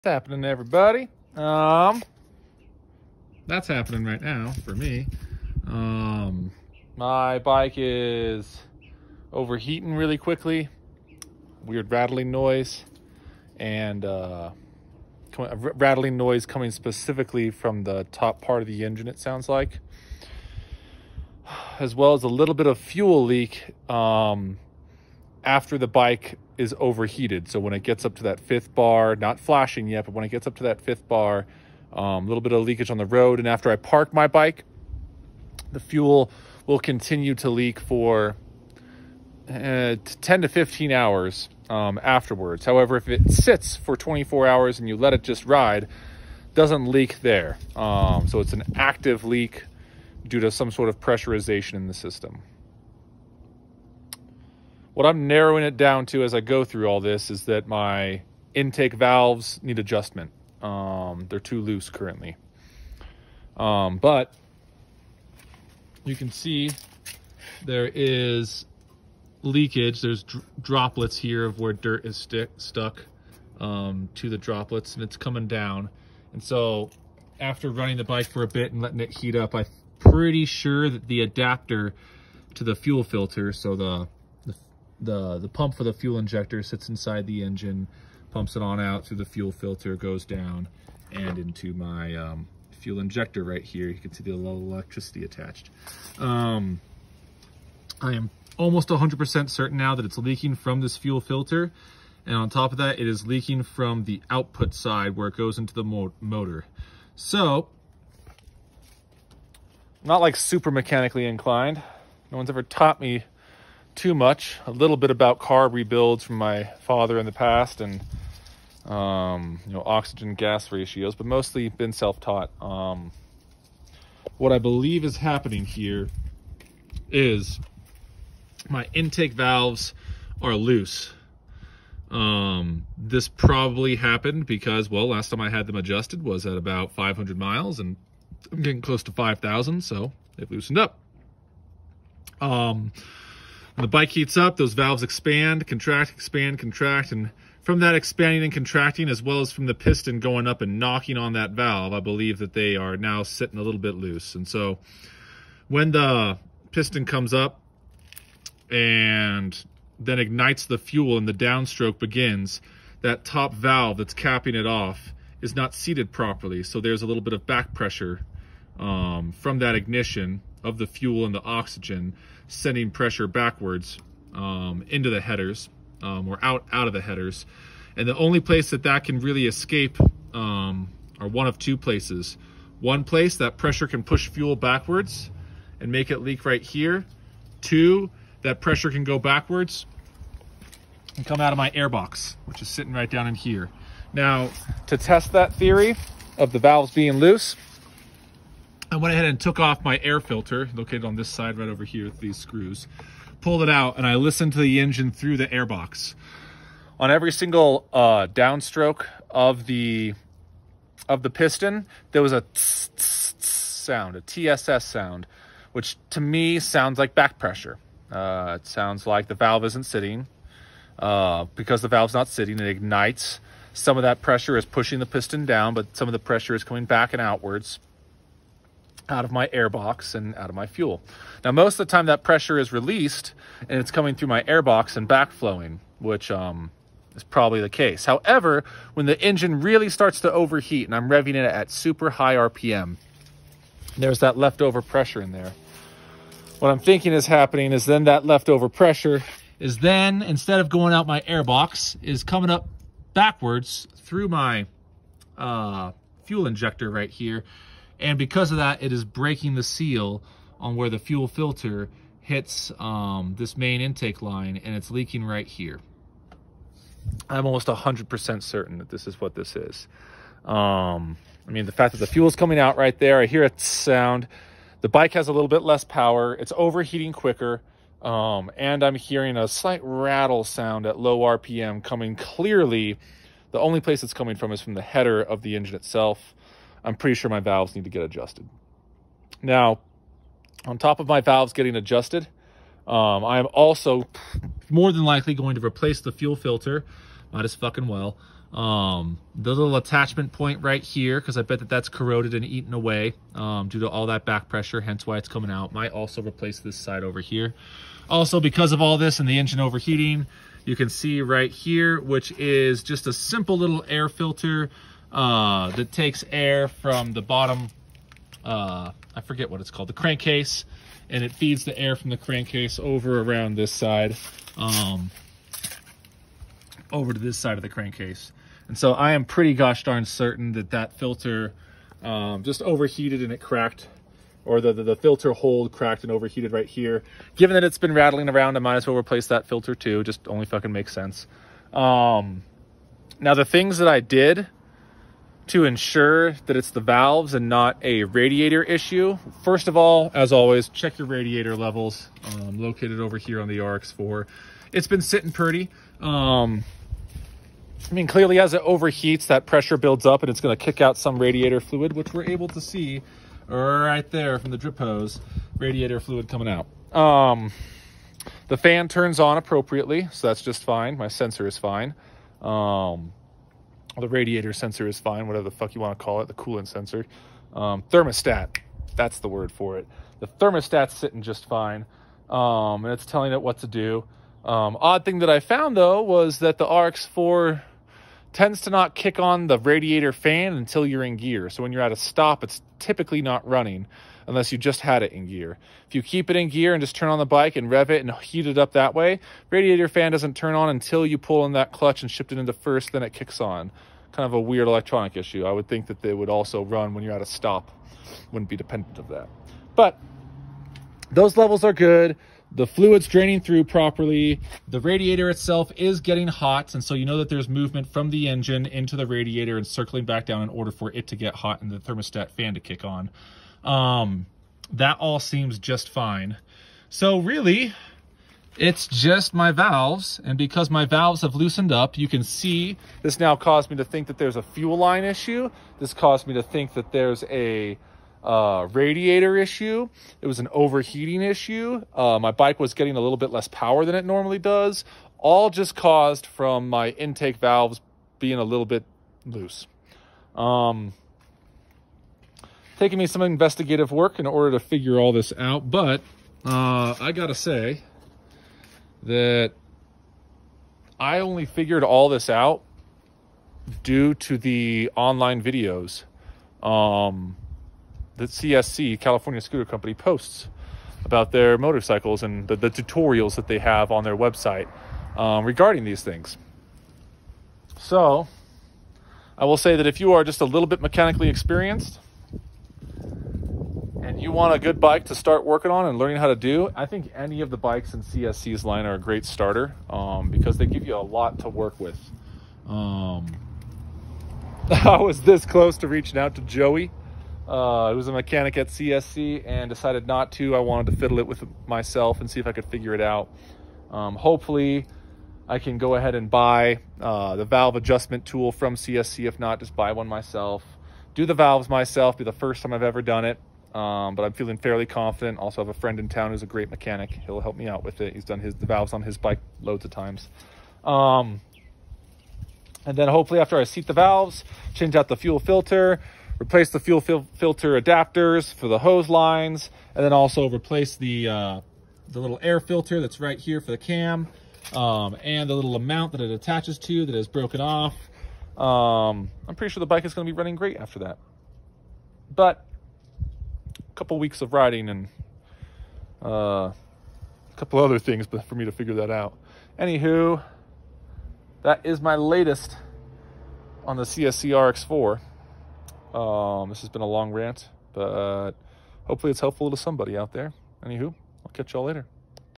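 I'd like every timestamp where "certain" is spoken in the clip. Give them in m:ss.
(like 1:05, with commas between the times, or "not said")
1:39, 4:28, 5:30.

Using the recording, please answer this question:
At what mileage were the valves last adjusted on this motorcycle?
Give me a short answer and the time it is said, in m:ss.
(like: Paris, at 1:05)
500 miles, at 2:16.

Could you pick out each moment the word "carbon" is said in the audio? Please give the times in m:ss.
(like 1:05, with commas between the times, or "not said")
not said.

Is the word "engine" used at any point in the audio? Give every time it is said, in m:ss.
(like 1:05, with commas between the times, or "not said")
0:18, 1:27, 3:24, 3:59, 4:45, 5:09, 6:58.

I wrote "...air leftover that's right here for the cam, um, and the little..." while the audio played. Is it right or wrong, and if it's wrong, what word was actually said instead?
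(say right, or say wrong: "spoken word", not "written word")
wrong: "filter", not "leftover".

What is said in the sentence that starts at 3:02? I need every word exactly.
One place, that pressure can push fuel backwards and make it leak right here.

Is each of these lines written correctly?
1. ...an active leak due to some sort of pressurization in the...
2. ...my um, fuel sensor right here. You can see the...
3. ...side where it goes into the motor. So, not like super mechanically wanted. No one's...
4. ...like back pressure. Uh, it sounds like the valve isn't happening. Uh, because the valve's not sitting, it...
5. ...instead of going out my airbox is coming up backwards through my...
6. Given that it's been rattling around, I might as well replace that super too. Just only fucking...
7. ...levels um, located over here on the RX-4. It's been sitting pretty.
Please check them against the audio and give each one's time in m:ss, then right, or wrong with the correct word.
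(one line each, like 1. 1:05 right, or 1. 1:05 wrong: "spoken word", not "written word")
1. 0:48 right
2. 1:31 wrong: "injector", not "sensor"
3. 1:44 wrong: "inclined", not "wanted"
4. 3:36 wrong: "sitting", not "happening"
5. 4:10 right
6. 5:37 wrong: "filter", not "super"
7. 5:51 right.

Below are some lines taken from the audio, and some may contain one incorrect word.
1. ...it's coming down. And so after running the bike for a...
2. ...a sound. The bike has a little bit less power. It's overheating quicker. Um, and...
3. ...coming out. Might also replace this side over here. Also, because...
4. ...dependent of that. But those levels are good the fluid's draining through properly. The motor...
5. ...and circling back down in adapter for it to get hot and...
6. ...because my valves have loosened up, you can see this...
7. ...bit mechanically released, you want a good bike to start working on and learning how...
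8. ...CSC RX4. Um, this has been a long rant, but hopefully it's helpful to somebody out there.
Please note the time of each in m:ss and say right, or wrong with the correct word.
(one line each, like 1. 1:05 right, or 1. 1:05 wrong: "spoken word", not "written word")
1. 1:15 right
2. 4:33 right
3. 5:05 right
4. 6:48 wrong: "radiator", not "motor"
5. 6:59 wrong: "order", not "adapter"
6. 7:10 right
7. 8:00 wrong: "experienced", not "released"
8. 9:14 right.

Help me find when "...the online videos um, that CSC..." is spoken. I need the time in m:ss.
7:44.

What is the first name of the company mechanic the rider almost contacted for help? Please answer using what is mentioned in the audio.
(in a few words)
Joey.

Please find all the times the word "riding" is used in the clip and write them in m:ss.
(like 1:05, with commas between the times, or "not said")
9:04.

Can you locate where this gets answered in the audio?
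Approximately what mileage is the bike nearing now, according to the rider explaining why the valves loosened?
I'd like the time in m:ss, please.
2:19.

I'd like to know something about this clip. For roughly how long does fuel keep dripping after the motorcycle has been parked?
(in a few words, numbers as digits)
10 to 15 hours.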